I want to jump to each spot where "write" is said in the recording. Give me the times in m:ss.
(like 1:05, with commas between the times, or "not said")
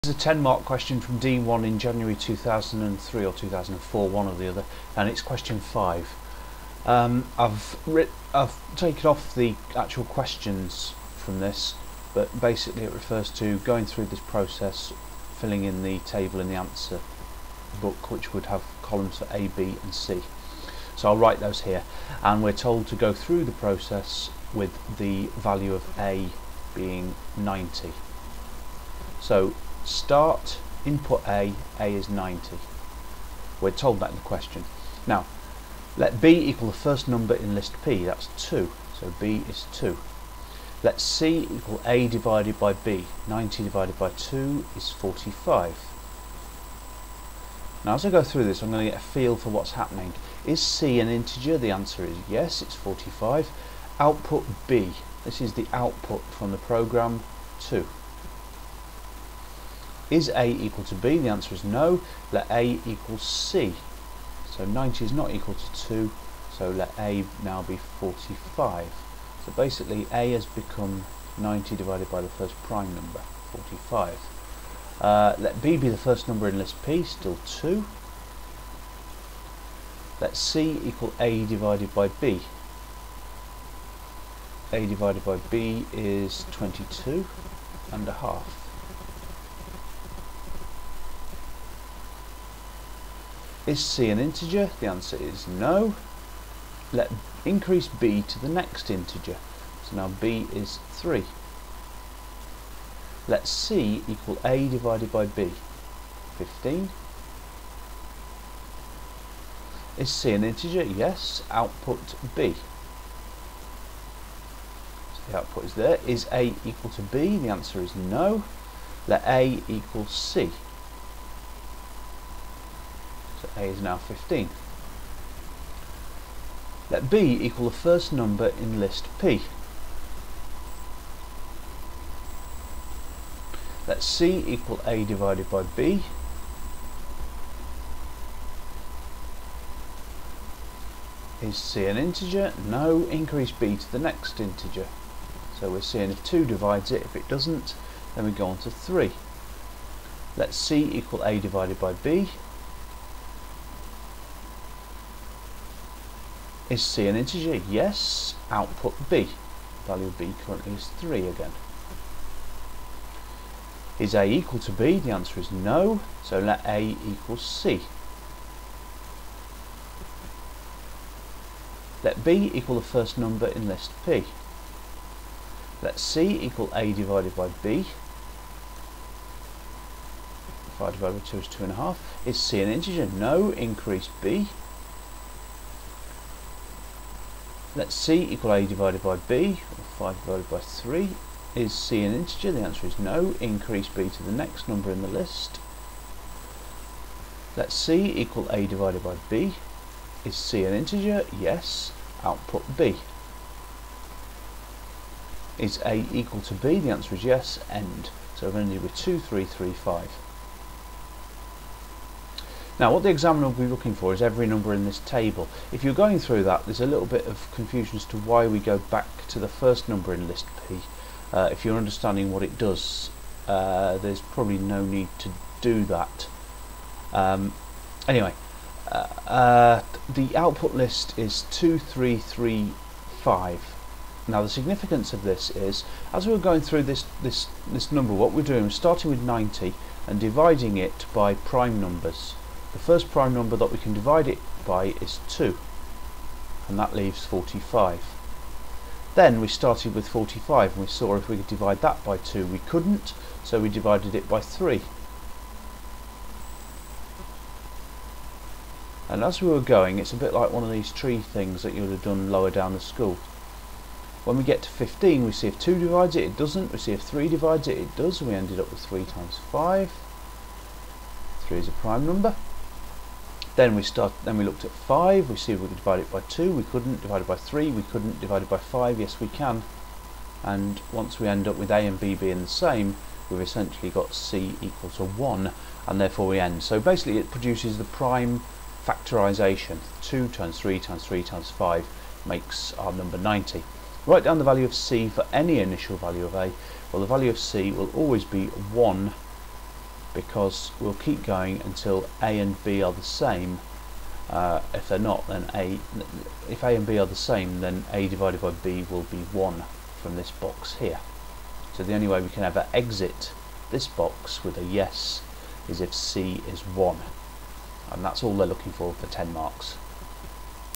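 0:21, 4:54.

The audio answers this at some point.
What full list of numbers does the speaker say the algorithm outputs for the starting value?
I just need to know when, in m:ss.
3:51.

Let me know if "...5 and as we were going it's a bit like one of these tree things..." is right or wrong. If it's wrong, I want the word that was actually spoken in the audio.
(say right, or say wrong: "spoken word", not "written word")
wrong: "3", not "5".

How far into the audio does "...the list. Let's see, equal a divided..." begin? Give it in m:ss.
3:15.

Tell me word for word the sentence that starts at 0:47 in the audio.
Now as I go through this I'm going to get a feel for what's happening.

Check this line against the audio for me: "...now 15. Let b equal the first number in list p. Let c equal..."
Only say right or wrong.
right.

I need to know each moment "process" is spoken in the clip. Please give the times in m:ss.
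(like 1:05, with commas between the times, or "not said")
0:14, 0:23.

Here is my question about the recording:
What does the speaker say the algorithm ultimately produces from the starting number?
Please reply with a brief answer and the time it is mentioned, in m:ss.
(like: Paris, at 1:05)
prime factorisation, at 4:47.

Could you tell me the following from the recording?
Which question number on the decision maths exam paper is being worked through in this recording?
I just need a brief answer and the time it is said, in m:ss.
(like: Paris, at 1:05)
5, at 0:05.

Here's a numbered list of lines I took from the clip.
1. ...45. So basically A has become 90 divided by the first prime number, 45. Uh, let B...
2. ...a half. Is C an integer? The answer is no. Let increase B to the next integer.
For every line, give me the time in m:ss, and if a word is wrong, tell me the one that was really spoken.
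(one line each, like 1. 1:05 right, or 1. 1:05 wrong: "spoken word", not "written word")
1. 1:07 right
2. 1:28 right.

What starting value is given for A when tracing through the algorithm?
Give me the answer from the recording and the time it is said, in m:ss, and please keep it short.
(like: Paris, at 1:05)
90, at 0:31.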